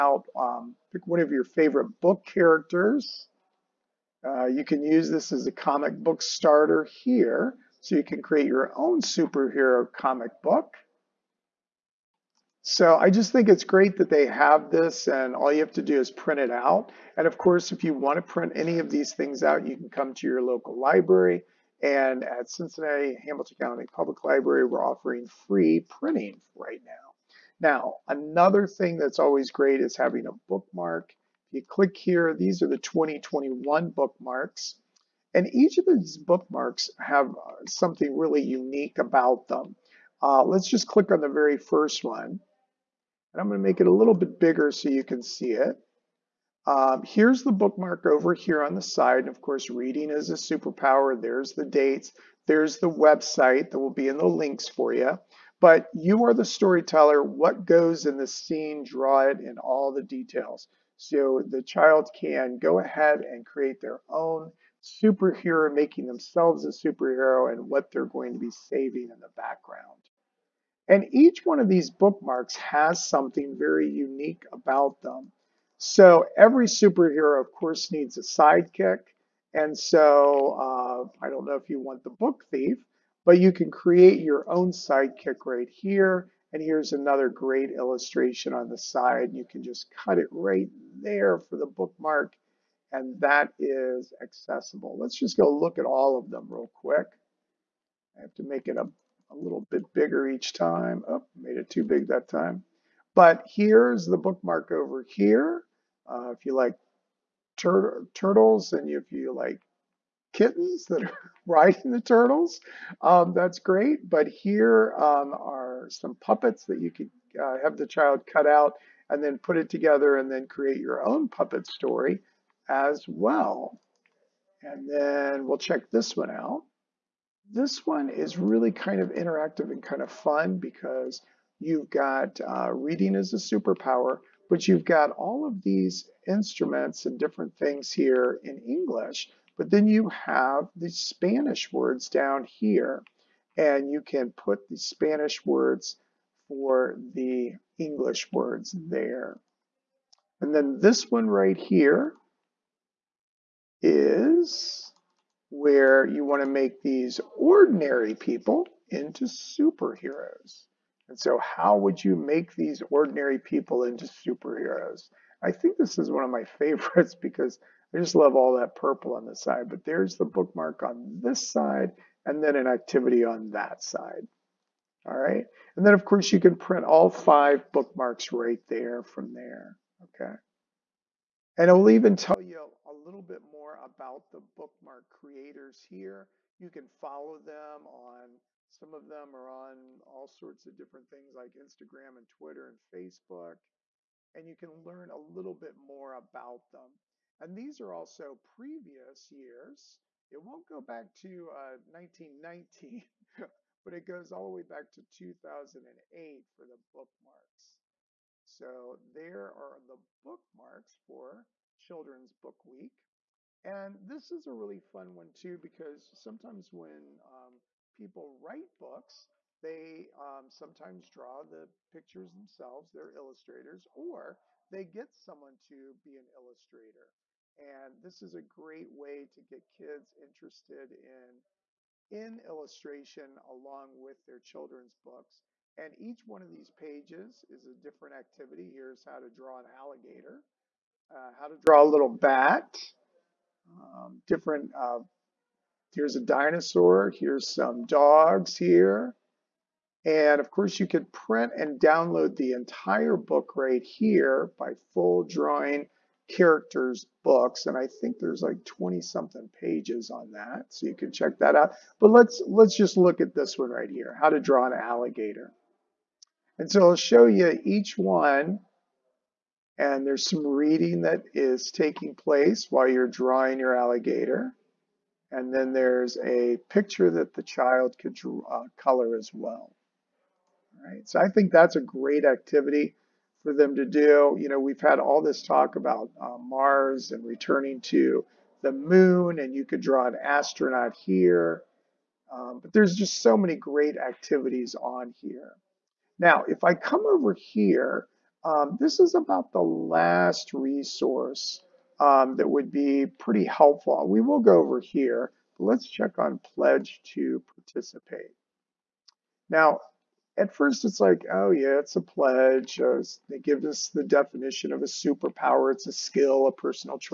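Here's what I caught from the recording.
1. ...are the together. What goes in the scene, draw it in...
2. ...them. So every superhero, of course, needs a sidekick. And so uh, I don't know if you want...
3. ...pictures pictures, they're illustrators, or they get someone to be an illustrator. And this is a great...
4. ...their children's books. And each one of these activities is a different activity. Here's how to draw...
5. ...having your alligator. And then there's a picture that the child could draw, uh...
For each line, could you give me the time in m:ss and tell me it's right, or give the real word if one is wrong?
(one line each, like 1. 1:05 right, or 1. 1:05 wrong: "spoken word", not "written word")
1. 0:56 wrong: "storyteller", not "together"
2. 1:15 right
3. 3:41 wrong: "themselves", not "pictures"
4. 3:54 wrong: "pages", not "activities"
5. 4:33 wrong: "drawing", not "having".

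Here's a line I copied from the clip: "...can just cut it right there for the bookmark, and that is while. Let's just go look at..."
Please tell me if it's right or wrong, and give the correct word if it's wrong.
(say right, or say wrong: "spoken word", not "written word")
wrong: "accessible", not "while".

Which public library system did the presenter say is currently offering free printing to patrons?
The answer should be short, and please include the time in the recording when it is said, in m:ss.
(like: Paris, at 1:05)
Cincinnati Hamilton County Public Library, at 0:22.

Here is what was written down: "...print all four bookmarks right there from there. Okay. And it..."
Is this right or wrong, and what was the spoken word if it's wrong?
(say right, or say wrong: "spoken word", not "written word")
wrong: "five", not "four".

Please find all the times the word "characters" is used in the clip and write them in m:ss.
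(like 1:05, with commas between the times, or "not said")
0:02, 4:16.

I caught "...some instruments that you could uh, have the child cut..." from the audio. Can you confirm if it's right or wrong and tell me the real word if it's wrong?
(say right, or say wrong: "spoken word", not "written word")
wrong: "puppets", not "instruments".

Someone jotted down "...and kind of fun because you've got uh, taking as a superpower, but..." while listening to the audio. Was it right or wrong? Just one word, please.
wrong.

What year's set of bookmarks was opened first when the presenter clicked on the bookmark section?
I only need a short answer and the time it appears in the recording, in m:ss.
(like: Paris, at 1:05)
2021, at 0:32.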